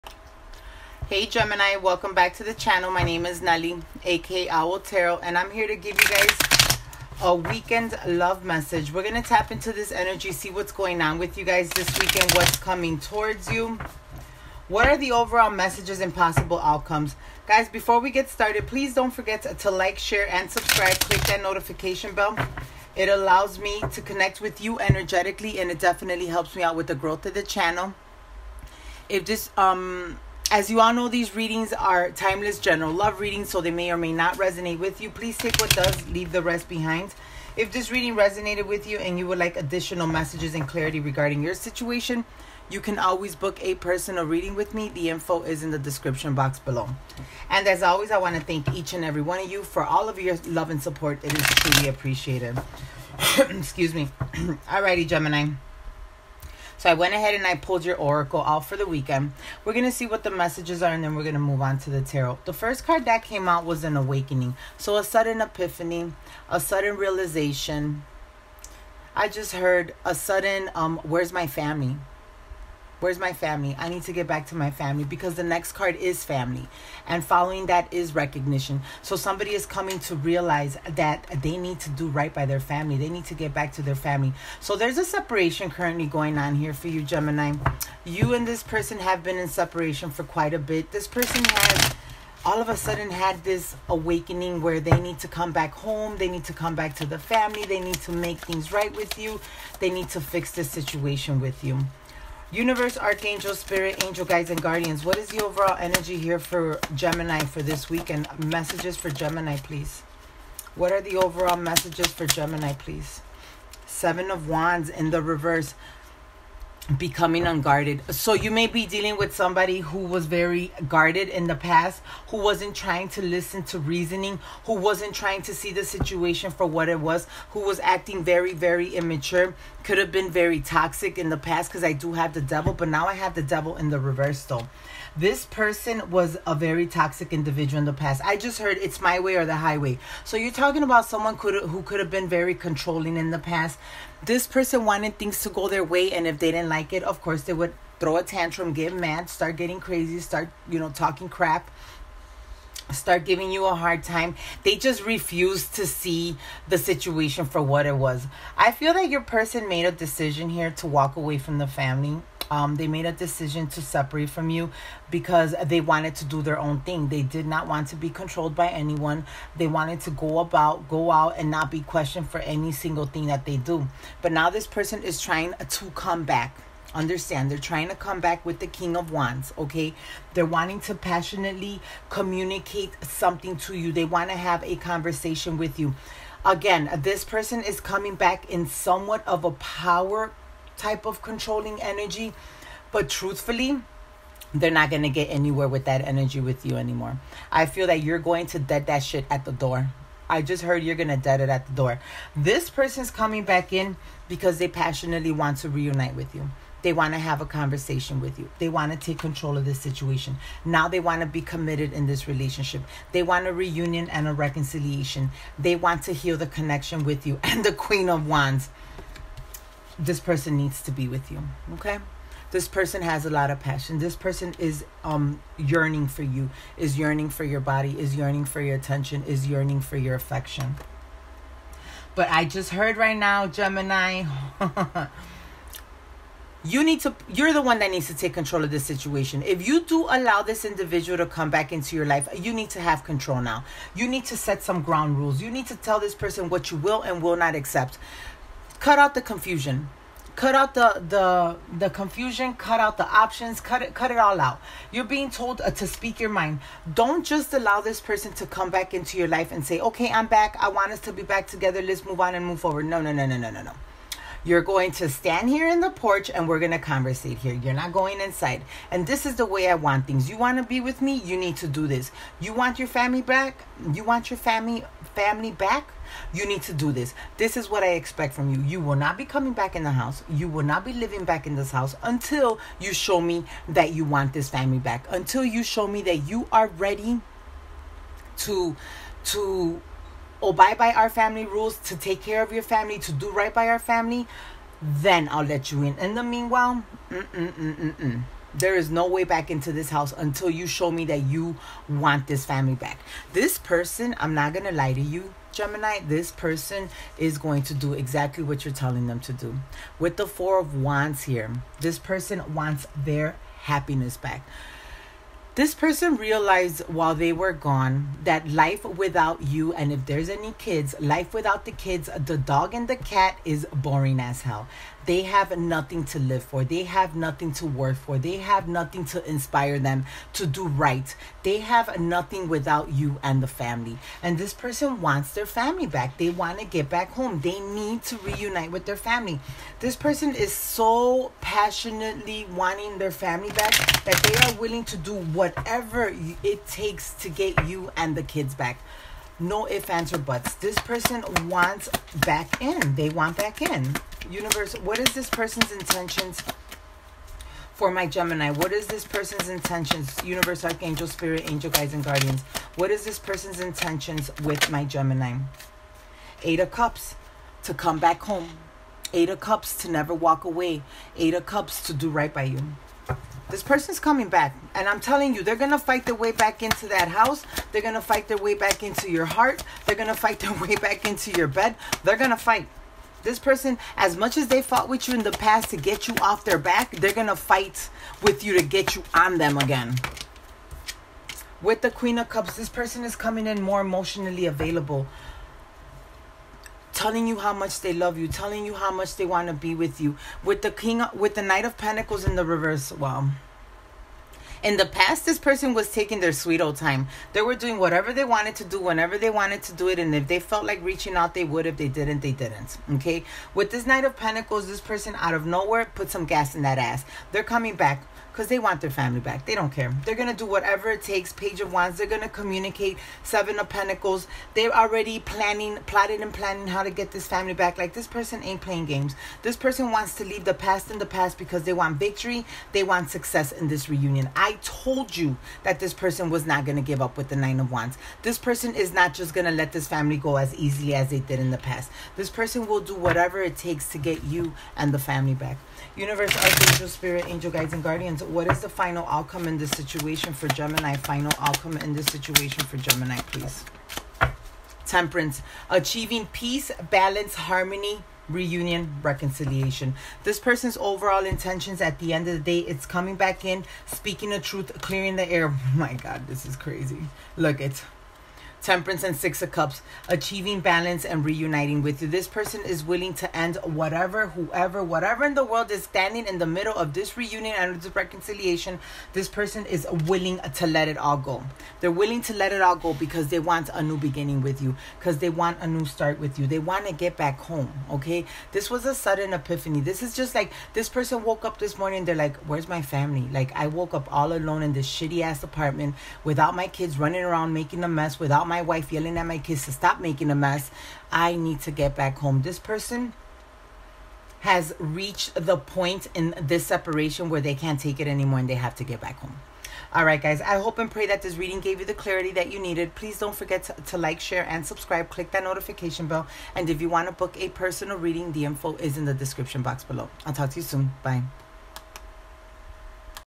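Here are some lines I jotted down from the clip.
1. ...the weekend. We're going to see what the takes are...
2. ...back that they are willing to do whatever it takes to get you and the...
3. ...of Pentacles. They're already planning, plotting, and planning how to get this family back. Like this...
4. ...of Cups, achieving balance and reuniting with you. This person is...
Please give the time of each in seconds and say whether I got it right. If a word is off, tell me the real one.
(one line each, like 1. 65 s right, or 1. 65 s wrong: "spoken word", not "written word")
1. 58 s wrong: "messages", not "takes"
2. 343 s right
3. 423 s right
4. 469 s right.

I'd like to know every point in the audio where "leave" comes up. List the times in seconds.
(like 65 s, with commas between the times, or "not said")
36 s, 430 s.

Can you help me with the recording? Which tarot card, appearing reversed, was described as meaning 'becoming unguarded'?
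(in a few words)
Seven of Wands.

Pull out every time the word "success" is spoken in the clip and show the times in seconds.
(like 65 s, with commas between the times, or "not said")
433 s.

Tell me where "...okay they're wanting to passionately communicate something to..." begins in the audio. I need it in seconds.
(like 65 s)
179 s.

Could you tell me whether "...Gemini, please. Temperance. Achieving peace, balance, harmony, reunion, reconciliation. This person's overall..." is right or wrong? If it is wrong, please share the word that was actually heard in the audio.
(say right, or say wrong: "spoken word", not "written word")
right.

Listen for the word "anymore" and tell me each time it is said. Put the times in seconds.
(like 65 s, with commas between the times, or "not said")
196 s, 508 s.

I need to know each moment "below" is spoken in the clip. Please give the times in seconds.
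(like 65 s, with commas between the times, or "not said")
46 s, 519 s.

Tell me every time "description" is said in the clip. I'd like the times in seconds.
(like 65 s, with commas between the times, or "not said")
45 s, 519 s.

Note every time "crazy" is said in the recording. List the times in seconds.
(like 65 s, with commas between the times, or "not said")
149 s, 466 s.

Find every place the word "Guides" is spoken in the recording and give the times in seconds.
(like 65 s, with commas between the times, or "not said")
104 s, 361 s, 447 s.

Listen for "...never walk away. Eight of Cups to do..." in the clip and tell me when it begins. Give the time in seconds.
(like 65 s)
369 s.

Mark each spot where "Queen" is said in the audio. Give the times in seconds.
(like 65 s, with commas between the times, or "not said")
217 s, 391 s.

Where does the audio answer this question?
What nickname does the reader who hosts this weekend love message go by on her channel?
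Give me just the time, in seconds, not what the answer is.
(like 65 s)
4 s.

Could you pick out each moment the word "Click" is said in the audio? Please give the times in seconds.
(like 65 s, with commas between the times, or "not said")
20 s, 515 s.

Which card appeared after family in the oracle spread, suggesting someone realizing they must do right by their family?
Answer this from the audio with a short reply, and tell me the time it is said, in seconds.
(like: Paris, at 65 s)
Recognition, at 78 s.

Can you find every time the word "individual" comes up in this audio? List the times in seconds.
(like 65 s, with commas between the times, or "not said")
137 s, 240 s.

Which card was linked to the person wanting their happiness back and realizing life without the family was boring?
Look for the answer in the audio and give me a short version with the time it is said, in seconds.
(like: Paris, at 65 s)
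Four of Wands, at 310 s.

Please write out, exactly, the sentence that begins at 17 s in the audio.
Guys, before we get started, please don't forget to like, share, and subscribe.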